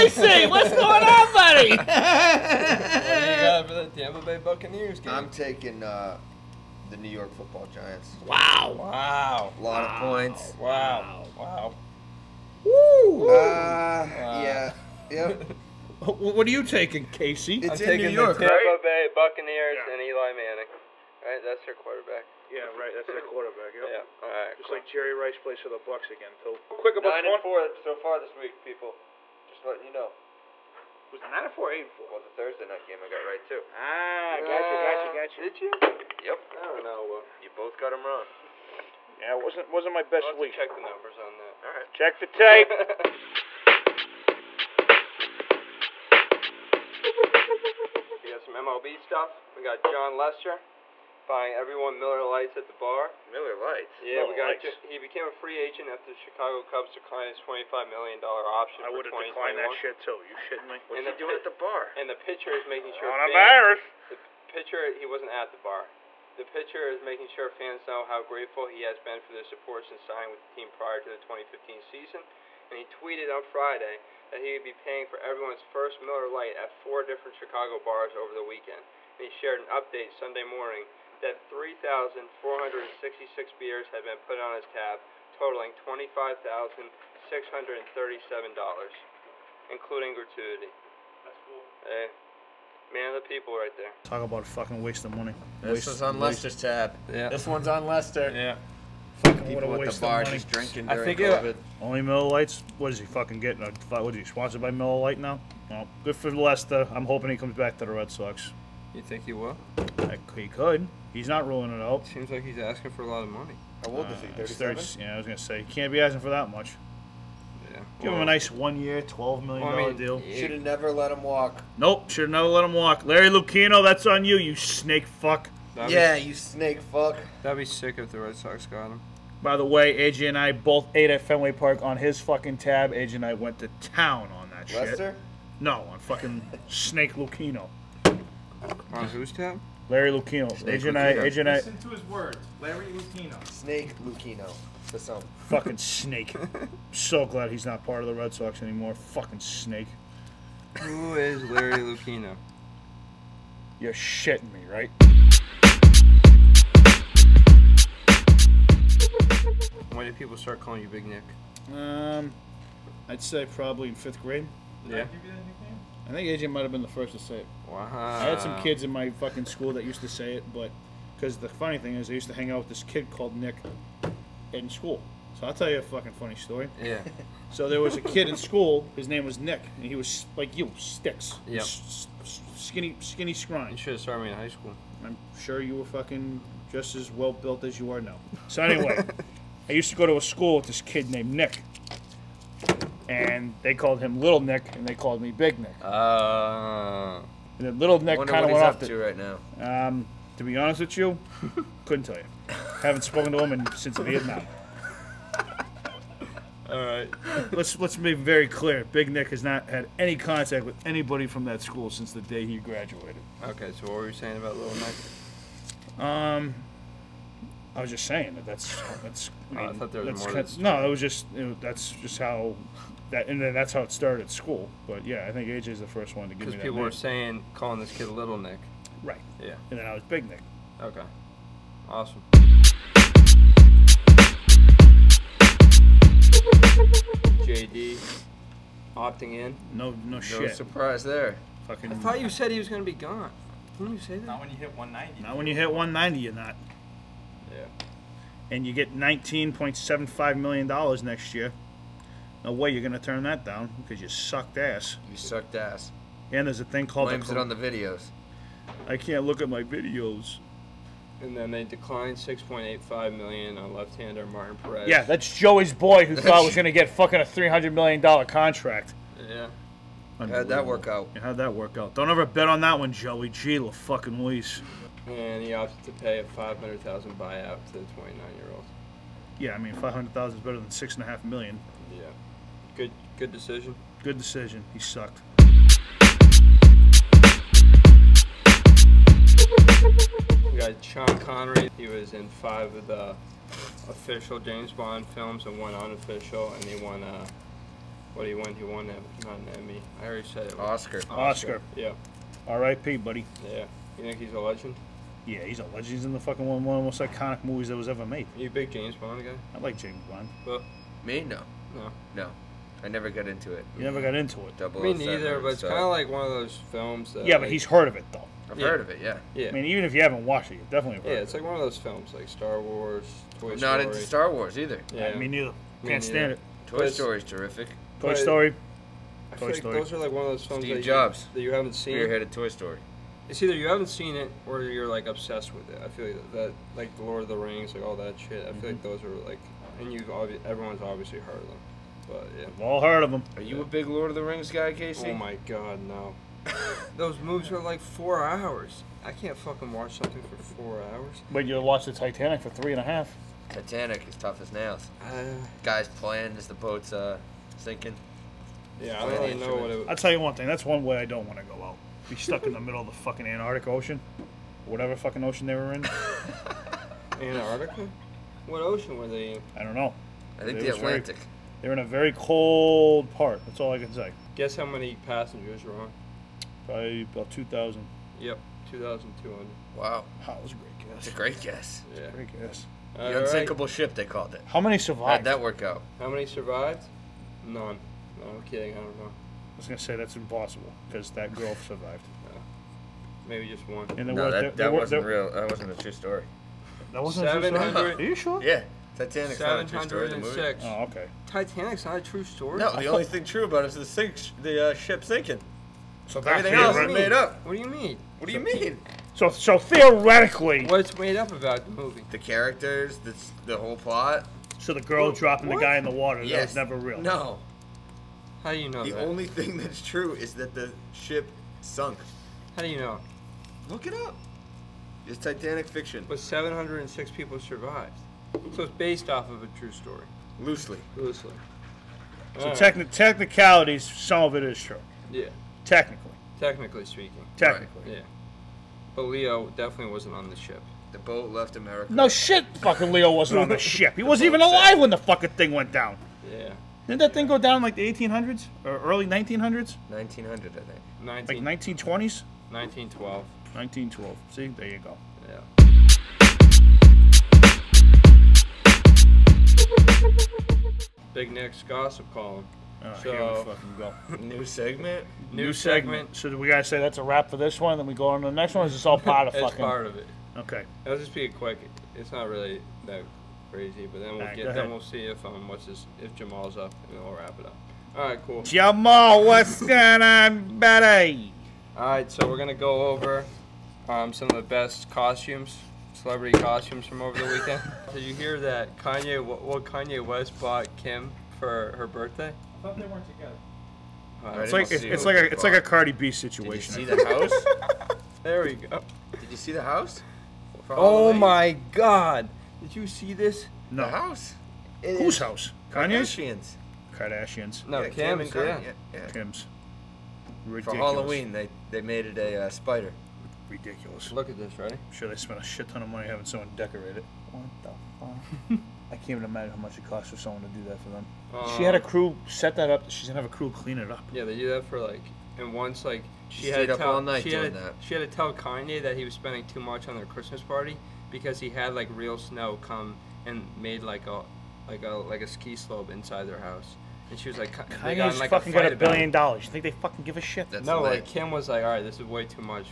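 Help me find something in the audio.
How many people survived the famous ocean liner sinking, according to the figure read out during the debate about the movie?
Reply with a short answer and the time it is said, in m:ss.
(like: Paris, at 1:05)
706, at 7:06.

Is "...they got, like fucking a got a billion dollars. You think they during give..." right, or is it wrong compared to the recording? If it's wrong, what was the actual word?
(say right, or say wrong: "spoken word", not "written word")
wrong: "fucking", not "during".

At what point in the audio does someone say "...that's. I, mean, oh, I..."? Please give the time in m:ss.
3:39.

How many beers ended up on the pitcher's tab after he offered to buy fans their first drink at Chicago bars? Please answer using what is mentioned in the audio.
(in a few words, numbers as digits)
3,466.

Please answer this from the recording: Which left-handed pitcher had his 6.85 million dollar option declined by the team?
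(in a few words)
Martin Perez.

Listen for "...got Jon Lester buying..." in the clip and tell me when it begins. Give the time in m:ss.
0:49.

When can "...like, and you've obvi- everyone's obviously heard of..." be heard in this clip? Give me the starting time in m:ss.
5:39.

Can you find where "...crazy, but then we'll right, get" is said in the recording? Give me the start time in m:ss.
7:53.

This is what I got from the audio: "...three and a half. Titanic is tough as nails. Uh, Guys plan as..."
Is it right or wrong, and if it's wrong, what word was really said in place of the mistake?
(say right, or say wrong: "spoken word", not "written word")
right.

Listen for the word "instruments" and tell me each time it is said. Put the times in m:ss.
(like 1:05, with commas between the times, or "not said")
not said.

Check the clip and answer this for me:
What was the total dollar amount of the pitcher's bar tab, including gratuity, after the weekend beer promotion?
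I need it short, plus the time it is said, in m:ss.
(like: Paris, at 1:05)
$25,637, at 1:25.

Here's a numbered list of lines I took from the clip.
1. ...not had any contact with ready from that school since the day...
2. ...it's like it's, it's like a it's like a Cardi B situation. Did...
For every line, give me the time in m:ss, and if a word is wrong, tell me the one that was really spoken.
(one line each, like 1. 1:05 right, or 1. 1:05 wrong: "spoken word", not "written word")
1. 3:29 wrong: "anybody", not "ready"
2. 8:14 right.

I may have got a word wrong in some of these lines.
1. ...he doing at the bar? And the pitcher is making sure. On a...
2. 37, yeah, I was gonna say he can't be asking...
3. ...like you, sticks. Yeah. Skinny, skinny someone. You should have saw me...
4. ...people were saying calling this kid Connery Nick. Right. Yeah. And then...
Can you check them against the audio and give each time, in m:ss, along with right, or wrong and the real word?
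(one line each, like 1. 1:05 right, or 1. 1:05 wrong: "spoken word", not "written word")
1. 1:01 right
2. 1:54 wrong: "30", not "37"
3. 3:00 wrong: "scrine", not "someone"
4. 3:46 wrong: "Little", not "Connery".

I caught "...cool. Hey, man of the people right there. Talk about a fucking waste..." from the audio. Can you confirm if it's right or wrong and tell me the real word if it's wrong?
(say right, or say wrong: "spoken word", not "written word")
right.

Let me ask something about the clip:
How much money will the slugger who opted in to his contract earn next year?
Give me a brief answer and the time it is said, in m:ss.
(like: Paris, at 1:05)
$19.75 million, at 4:08.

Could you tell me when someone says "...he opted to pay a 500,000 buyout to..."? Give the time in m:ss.
4:35.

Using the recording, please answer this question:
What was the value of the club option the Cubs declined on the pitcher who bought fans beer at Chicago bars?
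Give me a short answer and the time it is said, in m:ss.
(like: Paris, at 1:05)
$25 million, at 0:57.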